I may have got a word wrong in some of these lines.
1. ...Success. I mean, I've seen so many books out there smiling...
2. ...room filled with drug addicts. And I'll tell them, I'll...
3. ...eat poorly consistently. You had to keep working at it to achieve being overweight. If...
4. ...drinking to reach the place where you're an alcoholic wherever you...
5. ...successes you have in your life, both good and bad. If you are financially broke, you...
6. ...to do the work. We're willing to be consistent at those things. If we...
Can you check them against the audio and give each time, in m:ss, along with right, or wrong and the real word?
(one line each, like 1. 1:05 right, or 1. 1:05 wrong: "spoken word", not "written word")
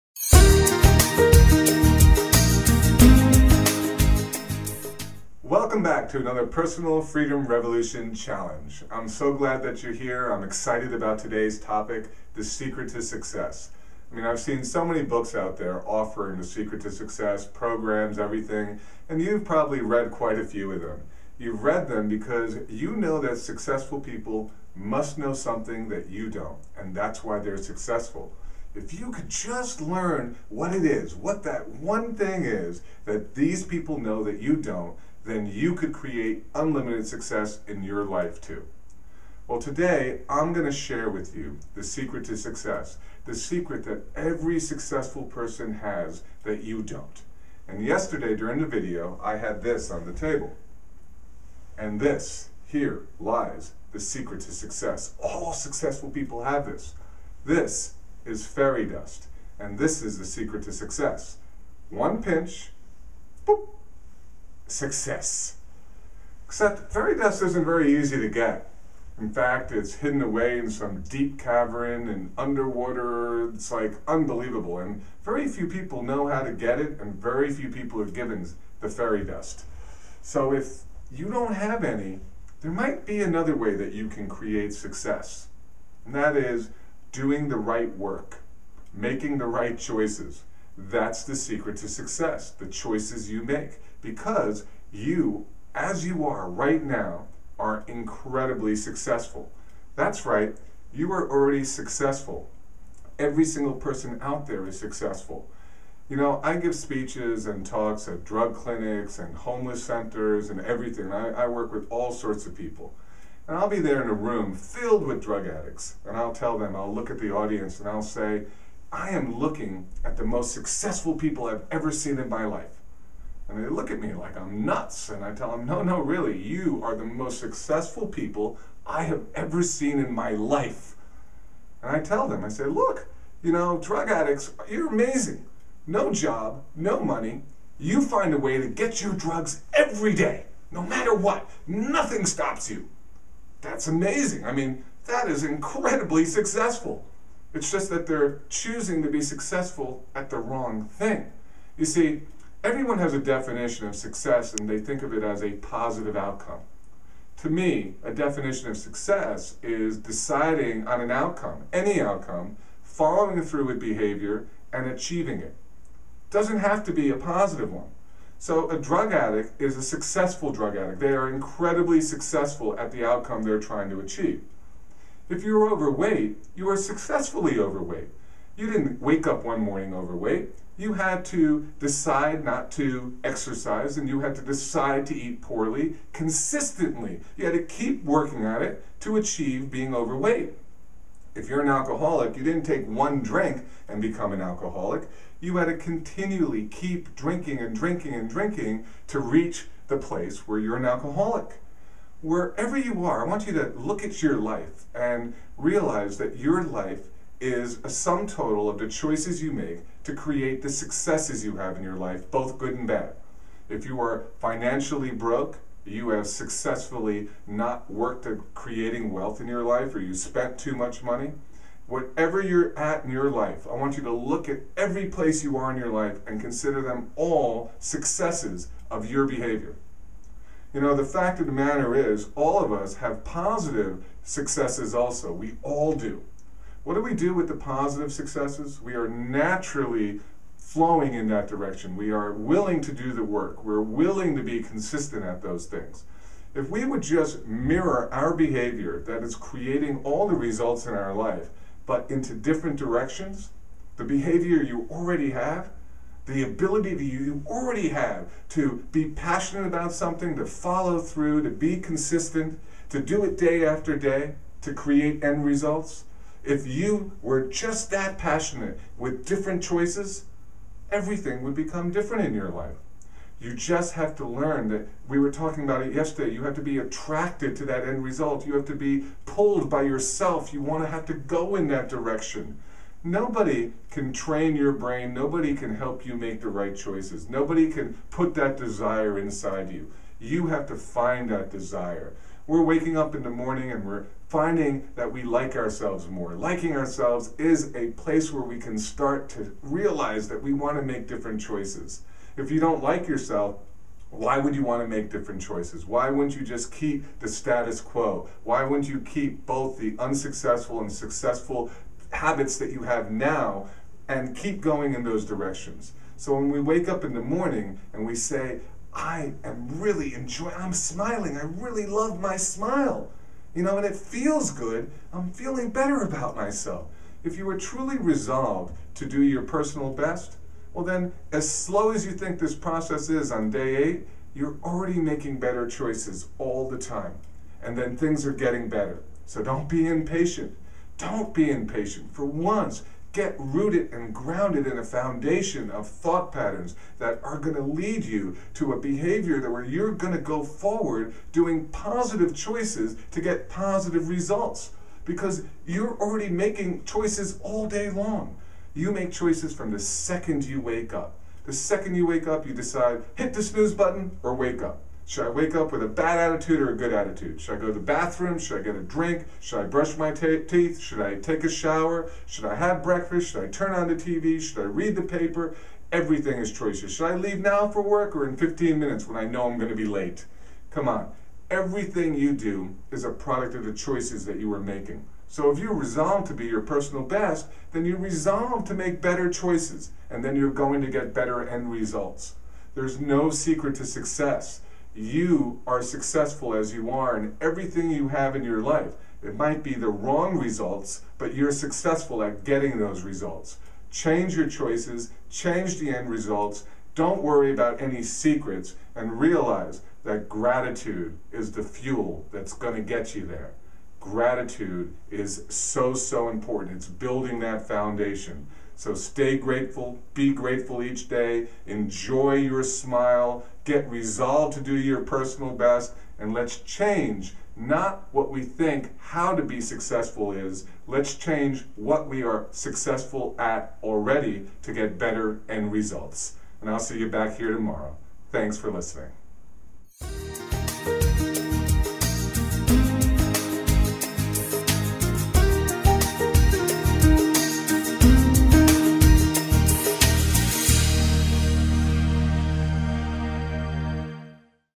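1. 0:13 wrong: "offering", not "smiling"
2. 1:54 right
3. 3:05 right
4. 3:18 right
5. 3:30 right
6. 4:02 right.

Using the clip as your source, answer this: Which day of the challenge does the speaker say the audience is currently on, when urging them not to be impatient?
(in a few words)
Day 8.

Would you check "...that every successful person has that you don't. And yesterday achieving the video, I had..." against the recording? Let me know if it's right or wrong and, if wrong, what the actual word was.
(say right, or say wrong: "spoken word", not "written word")
wrong: "during", not "achieving".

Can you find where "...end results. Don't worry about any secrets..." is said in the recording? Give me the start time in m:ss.
6:45.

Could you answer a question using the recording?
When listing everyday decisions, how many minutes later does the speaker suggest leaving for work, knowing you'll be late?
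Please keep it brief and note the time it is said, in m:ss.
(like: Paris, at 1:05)
15, at 6:18.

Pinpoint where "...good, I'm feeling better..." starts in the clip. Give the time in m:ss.
5:24.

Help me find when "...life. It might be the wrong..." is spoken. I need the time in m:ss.
6:38.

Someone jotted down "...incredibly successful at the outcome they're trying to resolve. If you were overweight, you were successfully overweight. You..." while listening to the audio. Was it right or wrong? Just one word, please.
wrong.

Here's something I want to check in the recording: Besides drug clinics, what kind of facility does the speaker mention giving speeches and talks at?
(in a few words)
Homeless centers.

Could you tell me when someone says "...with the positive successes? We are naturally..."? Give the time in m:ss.
3:57.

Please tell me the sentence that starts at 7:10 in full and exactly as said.
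Let's change what we are successful at already to get better end results.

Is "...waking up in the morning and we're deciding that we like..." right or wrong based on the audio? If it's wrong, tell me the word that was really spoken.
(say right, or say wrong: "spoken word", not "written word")
wrong: "finding", not "deciding".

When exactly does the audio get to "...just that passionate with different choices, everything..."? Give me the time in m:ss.
4:27.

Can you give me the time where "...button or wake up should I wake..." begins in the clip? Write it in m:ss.
6:03.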